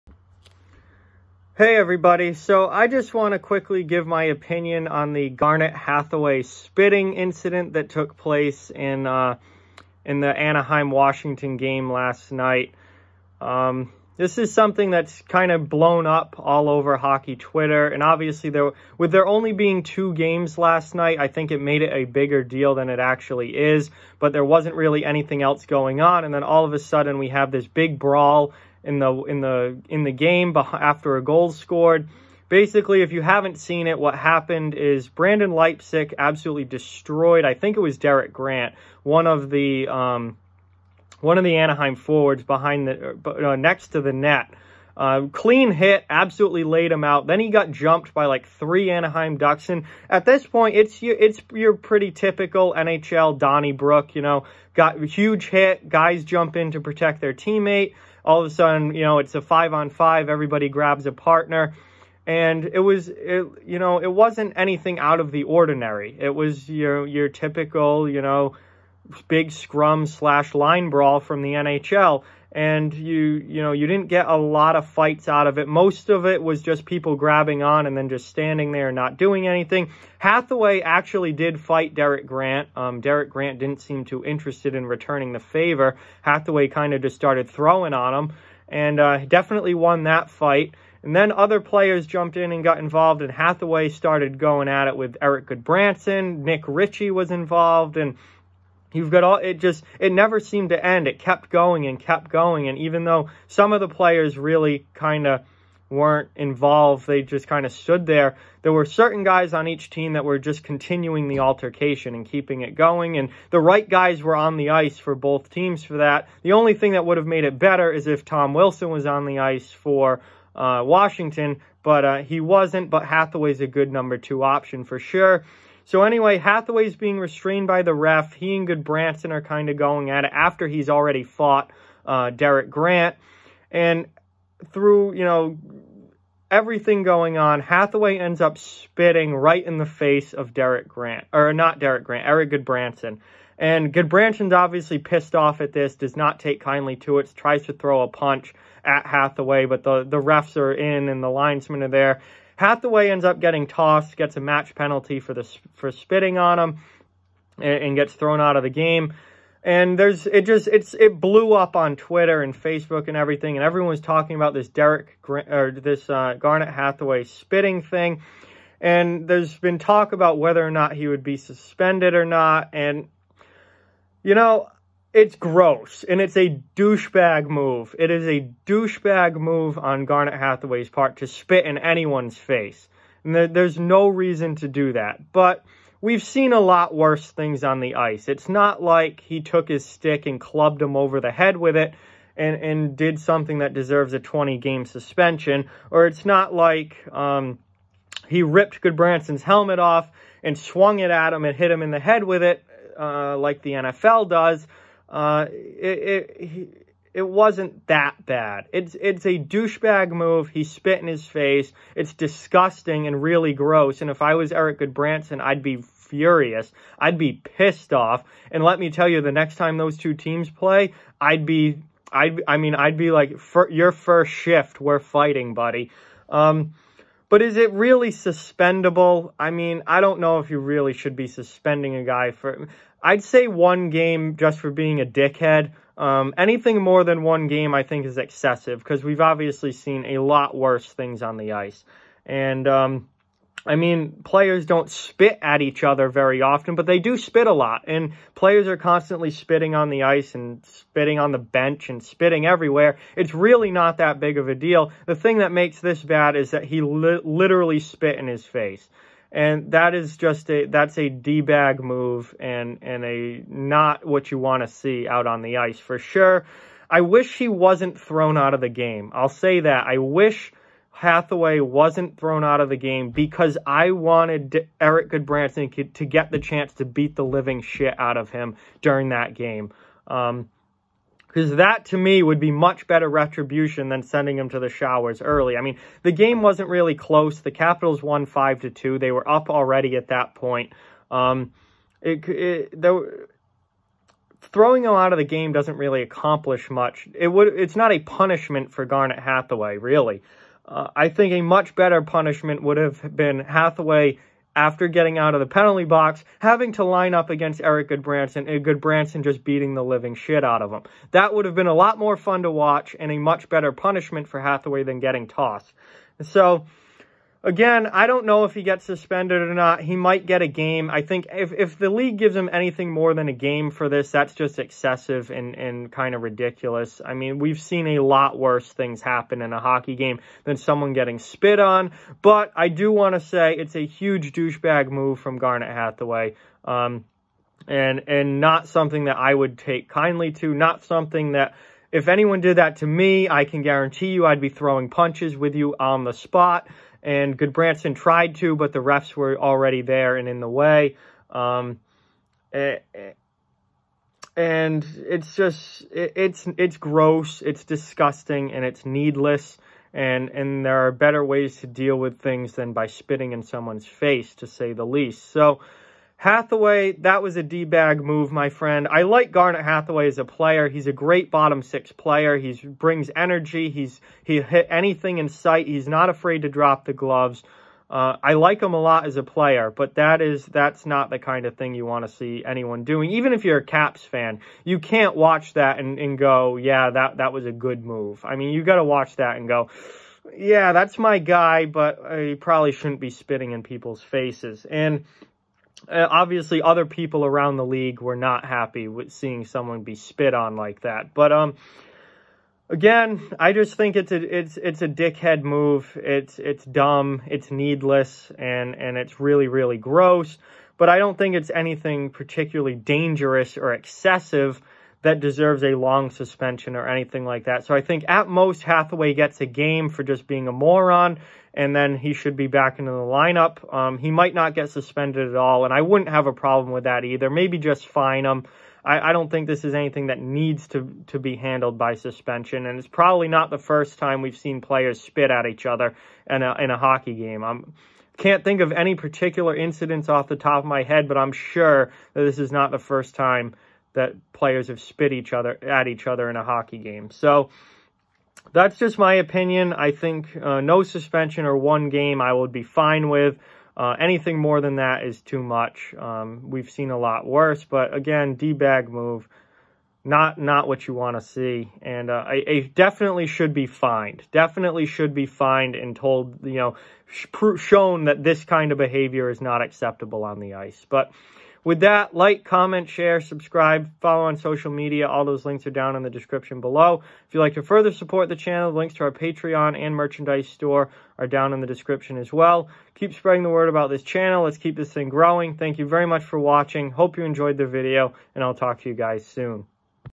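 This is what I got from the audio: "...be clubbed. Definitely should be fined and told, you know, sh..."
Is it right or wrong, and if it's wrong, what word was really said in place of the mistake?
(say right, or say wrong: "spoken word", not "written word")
wrong: "fined", not "clubbed".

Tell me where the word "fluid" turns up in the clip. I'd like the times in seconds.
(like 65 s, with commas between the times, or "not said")
not said.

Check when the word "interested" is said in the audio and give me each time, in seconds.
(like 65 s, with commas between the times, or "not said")
84 s.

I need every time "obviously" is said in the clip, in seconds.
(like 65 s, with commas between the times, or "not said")
18 s, 144 s, 239 s, 396 s.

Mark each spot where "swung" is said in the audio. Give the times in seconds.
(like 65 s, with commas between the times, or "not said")
200 s.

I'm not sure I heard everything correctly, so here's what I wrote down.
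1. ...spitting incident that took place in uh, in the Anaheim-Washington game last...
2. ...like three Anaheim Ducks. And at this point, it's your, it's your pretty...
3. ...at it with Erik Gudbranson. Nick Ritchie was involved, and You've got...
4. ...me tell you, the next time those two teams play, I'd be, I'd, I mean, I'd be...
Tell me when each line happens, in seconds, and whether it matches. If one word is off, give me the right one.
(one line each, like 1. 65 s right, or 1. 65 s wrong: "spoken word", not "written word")
1. 6 s right
2. 48 s right
3. 94 s right
4. 218 s right.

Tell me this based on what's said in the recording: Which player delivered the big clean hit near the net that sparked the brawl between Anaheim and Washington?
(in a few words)
Brendan Leipsic.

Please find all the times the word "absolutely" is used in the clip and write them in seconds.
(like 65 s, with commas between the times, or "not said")
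36 s, 46 s.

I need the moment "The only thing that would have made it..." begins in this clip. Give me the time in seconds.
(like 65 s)
116 s.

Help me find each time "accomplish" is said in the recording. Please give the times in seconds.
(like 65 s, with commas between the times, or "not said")
296 s.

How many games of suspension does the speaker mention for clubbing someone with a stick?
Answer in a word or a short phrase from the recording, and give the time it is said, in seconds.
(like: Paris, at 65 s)
20, at 194 s.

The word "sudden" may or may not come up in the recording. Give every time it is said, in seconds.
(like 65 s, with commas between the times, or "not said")
26 s, 58 s.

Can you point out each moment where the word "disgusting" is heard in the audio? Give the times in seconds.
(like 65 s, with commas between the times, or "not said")
212 s, 357 s.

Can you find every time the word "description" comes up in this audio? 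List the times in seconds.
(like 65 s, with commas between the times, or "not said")
476 s, 481 s.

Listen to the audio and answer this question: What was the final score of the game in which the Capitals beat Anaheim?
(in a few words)
5 to 2.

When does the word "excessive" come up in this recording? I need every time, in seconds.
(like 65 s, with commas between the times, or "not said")
238 s, 324 s, 413 s.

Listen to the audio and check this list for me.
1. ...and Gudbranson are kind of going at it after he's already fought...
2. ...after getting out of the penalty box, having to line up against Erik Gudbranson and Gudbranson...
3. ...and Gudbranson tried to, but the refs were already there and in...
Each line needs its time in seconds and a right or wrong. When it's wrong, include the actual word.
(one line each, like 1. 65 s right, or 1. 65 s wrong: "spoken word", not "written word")
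1. 128 s right
2. 304 s right
3. 347 s right.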